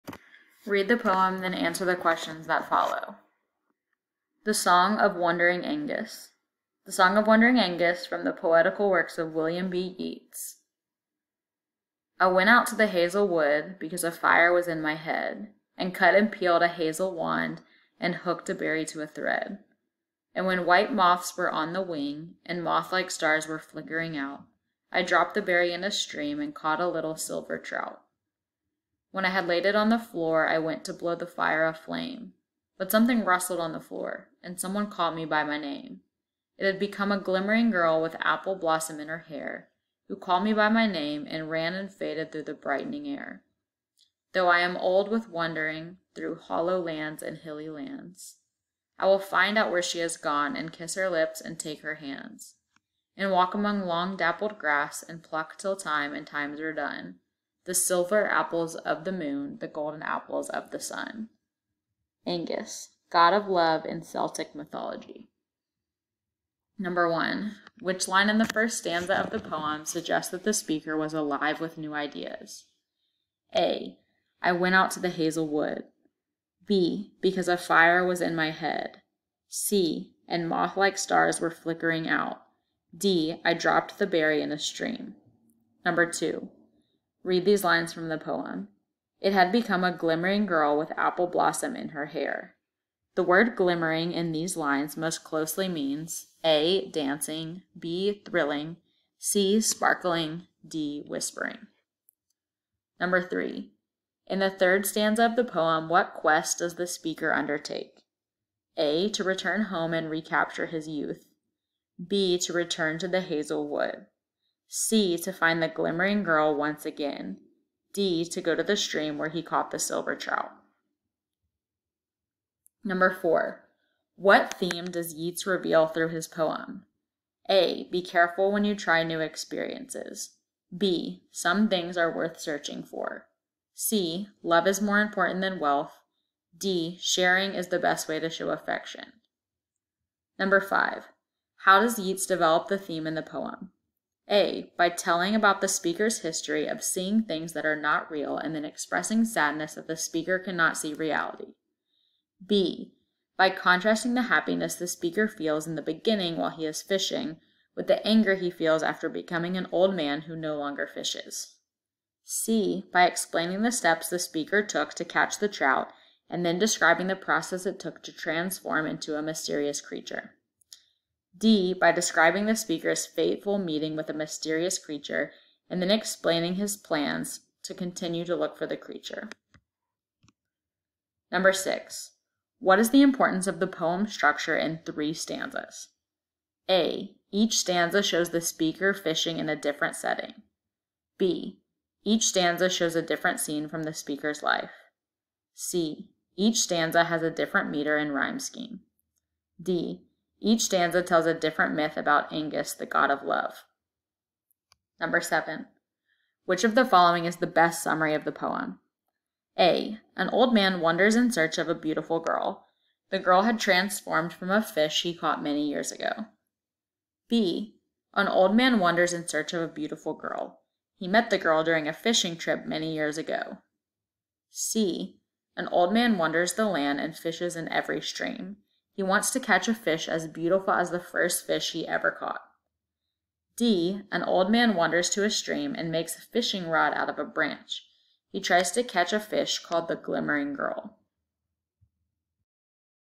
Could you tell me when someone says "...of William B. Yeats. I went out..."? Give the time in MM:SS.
00:09.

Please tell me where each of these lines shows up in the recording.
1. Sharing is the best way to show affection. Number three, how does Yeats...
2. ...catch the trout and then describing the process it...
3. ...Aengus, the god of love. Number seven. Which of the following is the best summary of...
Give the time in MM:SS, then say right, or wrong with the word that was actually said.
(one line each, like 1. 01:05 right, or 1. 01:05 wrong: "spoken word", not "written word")
1. 02:17 wrong: "five", not "three"
2. 02:45 right
3. 03:22 right.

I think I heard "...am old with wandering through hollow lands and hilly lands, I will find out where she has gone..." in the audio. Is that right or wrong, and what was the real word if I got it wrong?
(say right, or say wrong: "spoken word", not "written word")
right.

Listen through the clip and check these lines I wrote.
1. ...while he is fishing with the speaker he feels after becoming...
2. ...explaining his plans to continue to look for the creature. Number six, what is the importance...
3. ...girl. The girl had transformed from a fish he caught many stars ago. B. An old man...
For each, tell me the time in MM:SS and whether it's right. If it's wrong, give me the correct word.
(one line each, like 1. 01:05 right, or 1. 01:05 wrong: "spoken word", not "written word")
1. 02:36 wrong: "anger", not "speaker"
2. 02:55 right
3. 03:32 wrong: "years", not "stars".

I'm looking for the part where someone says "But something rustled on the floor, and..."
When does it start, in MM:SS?
00:32.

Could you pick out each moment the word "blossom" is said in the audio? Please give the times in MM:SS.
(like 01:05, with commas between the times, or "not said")
00:38, 01:31.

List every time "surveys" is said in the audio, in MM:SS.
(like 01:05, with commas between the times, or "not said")
not said.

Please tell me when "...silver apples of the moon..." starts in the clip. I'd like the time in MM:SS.
00:57.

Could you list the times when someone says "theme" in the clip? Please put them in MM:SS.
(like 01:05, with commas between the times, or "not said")
02:04, 02:22.